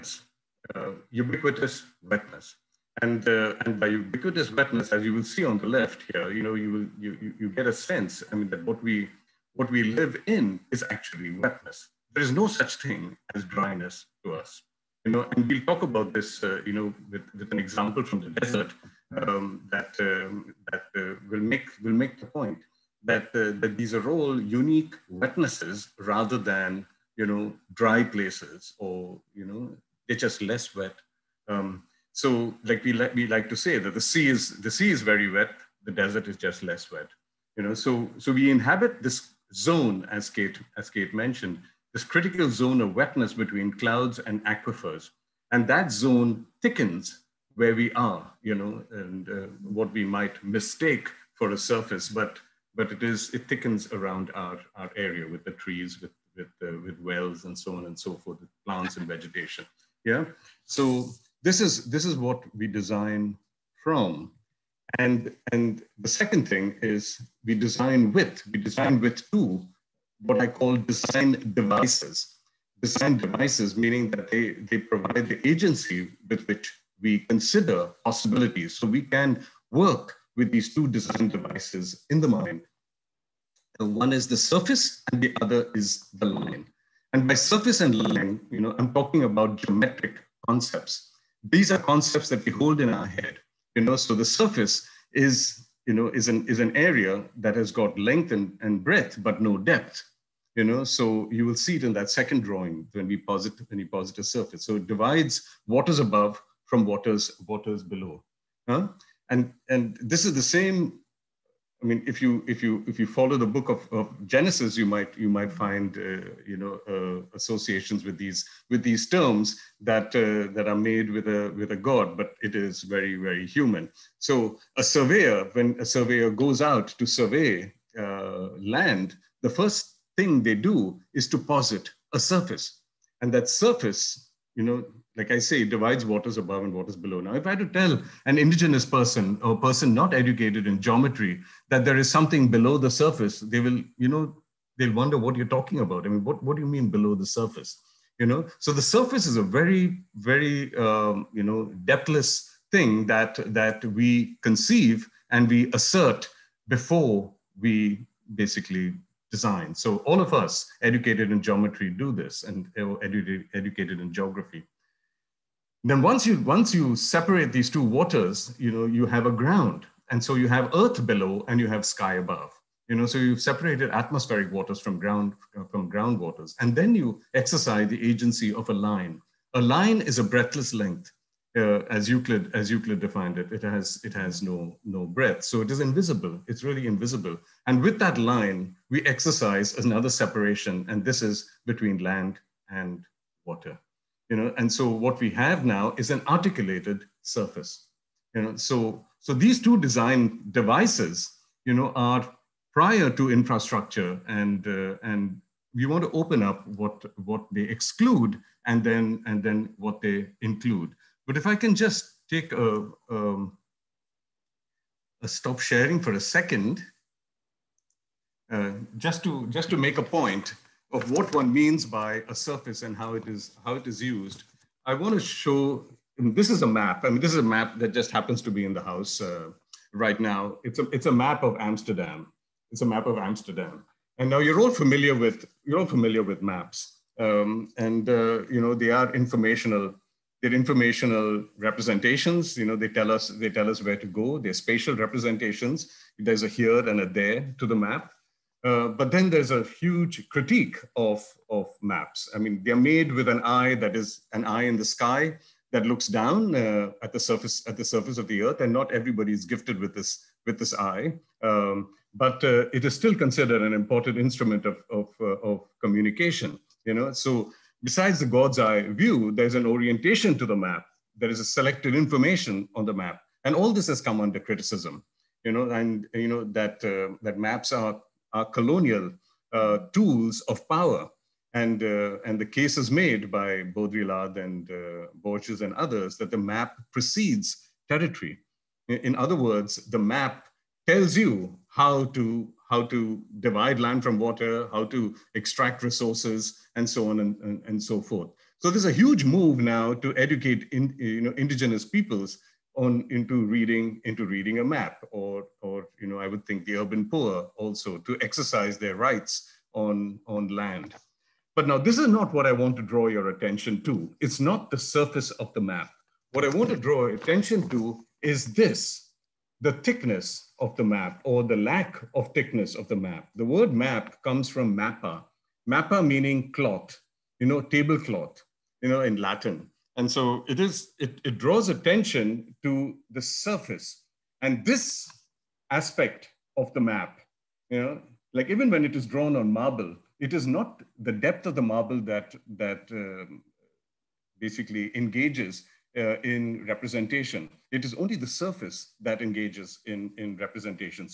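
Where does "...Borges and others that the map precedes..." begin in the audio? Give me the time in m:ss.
4:45.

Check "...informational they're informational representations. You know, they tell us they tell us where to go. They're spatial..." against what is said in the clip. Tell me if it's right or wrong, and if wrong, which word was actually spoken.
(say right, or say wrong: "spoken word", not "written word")
right.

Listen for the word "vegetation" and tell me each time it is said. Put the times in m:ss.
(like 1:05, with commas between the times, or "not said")
0:59.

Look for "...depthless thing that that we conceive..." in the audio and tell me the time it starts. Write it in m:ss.
2:31.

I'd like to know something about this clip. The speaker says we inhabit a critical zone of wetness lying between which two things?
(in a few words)
Clouds and aquifers.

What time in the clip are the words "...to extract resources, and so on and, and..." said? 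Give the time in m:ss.
4:54.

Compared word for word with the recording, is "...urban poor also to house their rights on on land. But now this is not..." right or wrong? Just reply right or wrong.
wrong.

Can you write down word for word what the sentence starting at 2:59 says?
A line is a breathless length uh, as Euclid as Euclid defined it, it has it has no no breadth.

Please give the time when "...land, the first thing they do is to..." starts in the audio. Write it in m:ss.
2:08.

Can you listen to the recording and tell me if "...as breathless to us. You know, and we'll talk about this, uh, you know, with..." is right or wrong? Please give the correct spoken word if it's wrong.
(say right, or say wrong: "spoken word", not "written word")
wrong: "dryness", not "breathless".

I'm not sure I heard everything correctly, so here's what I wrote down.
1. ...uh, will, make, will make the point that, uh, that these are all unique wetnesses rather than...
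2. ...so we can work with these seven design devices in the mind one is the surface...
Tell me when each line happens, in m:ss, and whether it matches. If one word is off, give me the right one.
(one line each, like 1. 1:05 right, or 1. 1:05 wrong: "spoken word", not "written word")
1. 0:20 right
2. 1:18 wrong: "two", not "seven".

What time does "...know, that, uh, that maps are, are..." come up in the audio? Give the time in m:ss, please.
4:36.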